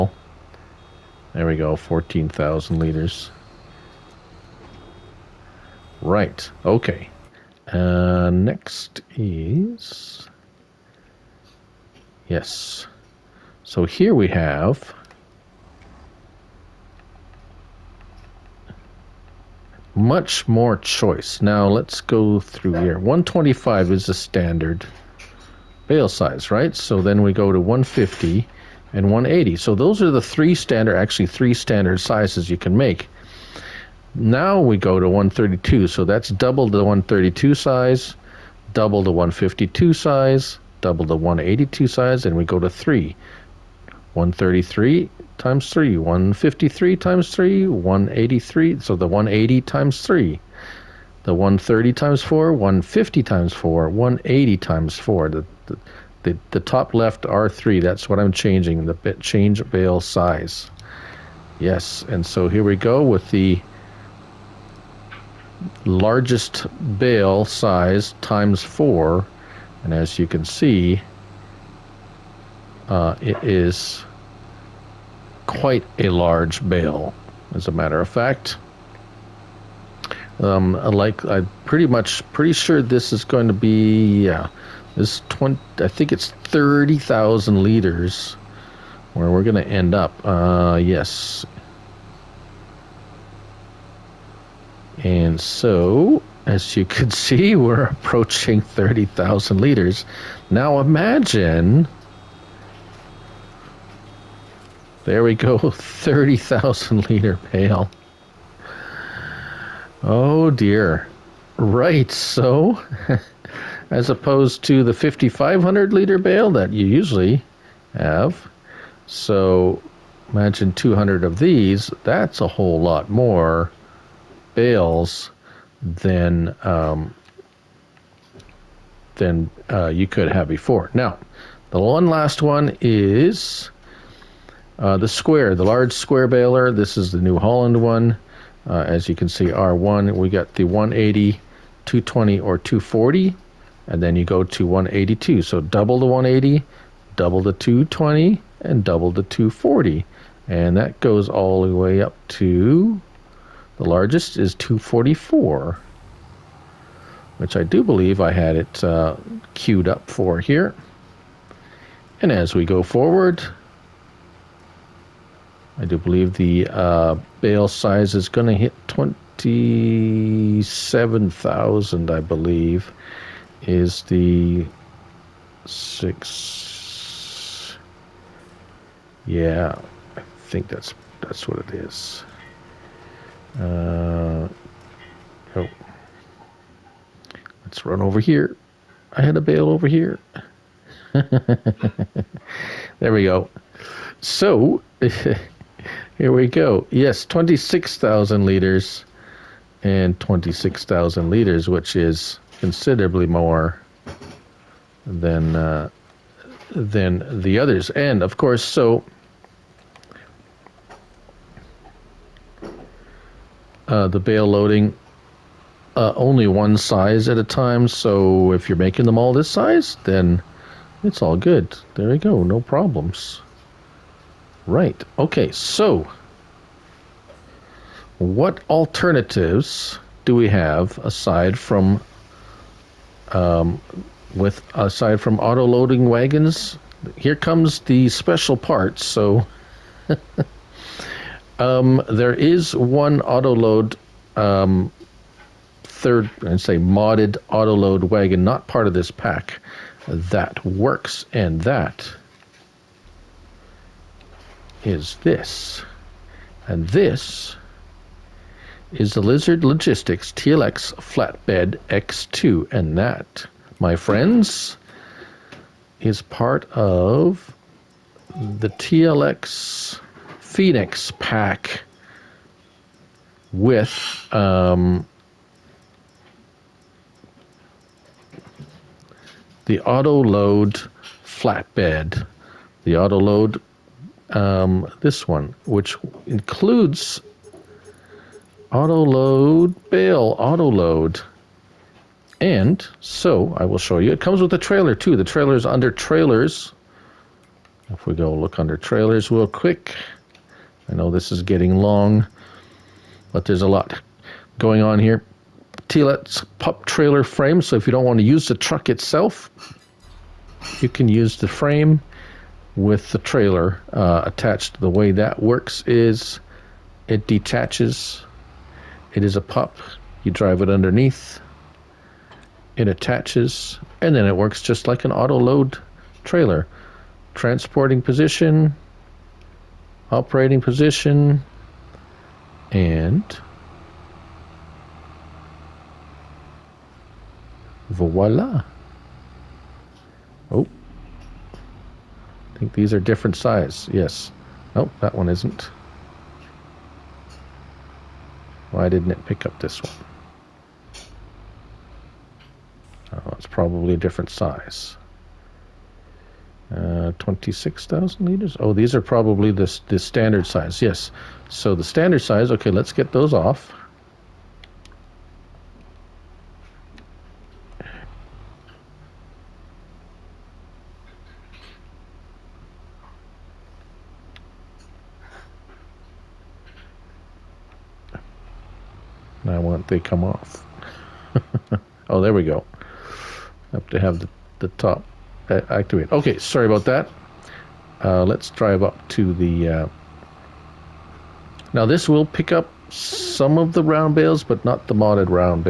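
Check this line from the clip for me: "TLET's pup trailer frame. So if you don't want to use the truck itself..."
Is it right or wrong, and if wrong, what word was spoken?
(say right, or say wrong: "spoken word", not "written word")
right.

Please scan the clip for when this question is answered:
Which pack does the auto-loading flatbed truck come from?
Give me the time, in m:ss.
4:28.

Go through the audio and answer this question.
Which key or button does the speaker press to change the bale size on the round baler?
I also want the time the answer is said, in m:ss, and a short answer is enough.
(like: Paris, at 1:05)
R3, at 0:57.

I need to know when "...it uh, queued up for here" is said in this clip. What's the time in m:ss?
2:38.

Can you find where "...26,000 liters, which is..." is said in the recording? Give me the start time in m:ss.
3:20.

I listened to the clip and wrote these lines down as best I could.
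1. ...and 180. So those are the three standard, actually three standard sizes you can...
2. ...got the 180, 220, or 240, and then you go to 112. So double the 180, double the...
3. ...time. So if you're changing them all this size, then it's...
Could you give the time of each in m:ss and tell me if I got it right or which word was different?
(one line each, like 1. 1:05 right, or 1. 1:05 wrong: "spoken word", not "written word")
1. 0:28 right
2. 2:20 wrong: "182", not "112"
3. 3:37 wrong: "making", not "changing".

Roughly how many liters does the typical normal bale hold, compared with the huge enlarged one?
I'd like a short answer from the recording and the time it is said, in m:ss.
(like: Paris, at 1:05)
5,500 liters, at 1:54.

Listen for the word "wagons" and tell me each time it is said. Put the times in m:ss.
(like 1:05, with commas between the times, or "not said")
3:56, 4:08.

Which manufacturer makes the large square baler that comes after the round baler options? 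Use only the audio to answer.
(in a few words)
New Holland.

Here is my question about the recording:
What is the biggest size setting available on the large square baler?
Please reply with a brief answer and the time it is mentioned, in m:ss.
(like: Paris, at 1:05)
244, at 2:34.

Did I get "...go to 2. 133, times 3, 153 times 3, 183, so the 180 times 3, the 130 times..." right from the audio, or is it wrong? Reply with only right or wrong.
wrong.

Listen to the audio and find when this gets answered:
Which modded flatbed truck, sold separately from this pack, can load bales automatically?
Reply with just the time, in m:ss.
4:19.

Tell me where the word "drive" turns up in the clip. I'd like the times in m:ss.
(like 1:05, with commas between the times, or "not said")
5:20, 6:28.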